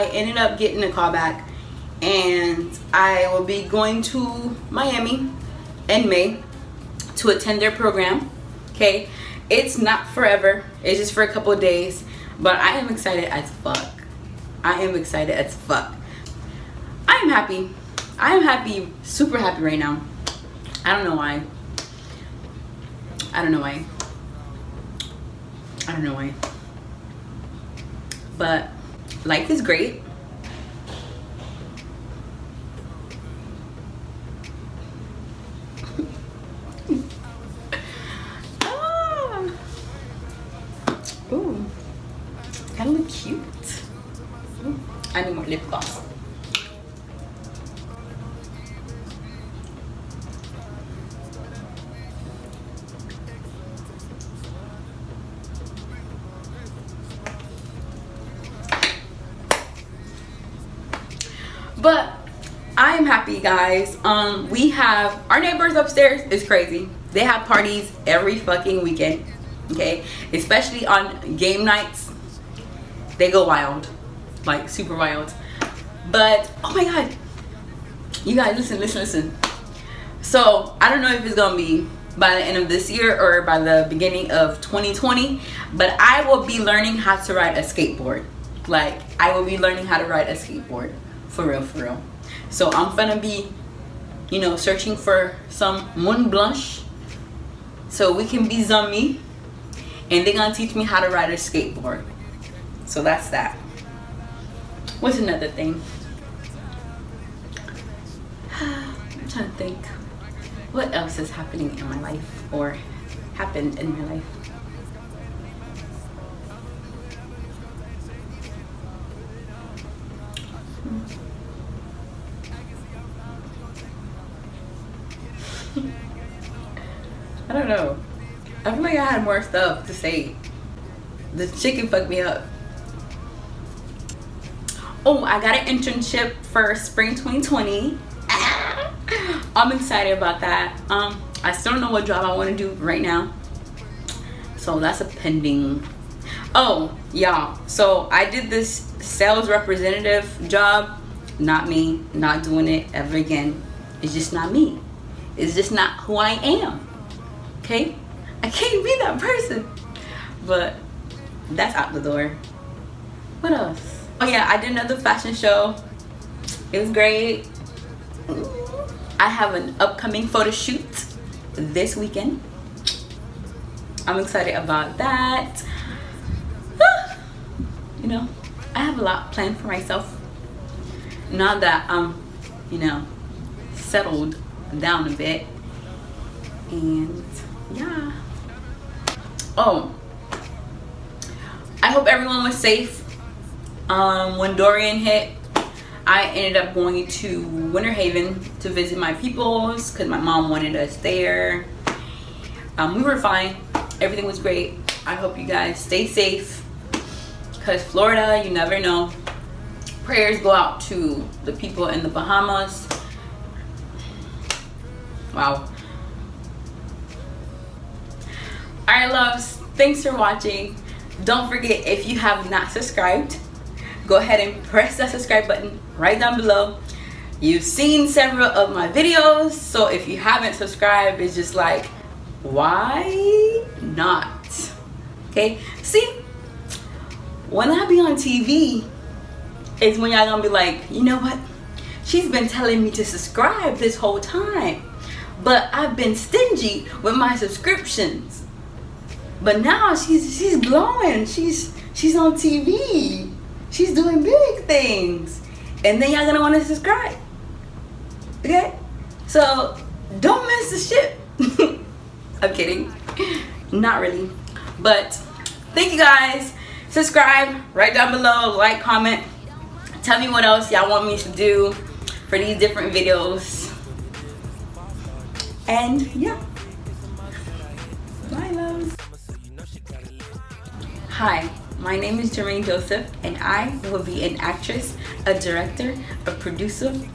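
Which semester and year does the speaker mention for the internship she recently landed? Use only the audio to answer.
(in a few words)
spring 2020.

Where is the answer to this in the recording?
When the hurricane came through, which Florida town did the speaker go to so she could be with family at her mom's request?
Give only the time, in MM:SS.
03:17.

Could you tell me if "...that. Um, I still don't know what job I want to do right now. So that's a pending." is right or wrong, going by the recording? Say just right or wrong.
right.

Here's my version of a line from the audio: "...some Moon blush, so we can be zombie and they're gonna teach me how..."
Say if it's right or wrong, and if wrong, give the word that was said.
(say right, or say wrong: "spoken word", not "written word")
right.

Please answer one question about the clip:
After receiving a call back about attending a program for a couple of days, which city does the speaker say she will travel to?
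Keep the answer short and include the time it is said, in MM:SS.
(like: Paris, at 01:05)
Miami, at 00:04.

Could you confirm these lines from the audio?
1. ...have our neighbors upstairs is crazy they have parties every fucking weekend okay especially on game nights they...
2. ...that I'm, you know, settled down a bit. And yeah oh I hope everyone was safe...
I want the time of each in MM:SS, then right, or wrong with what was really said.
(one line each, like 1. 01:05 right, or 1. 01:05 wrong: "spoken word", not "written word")
1. 01:04 right
2. 03:01 right.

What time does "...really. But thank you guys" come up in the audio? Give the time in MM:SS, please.
04:24.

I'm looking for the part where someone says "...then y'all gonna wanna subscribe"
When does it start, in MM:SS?
04:16.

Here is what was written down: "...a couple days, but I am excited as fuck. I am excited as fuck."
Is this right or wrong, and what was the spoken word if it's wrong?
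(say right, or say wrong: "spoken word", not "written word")
right.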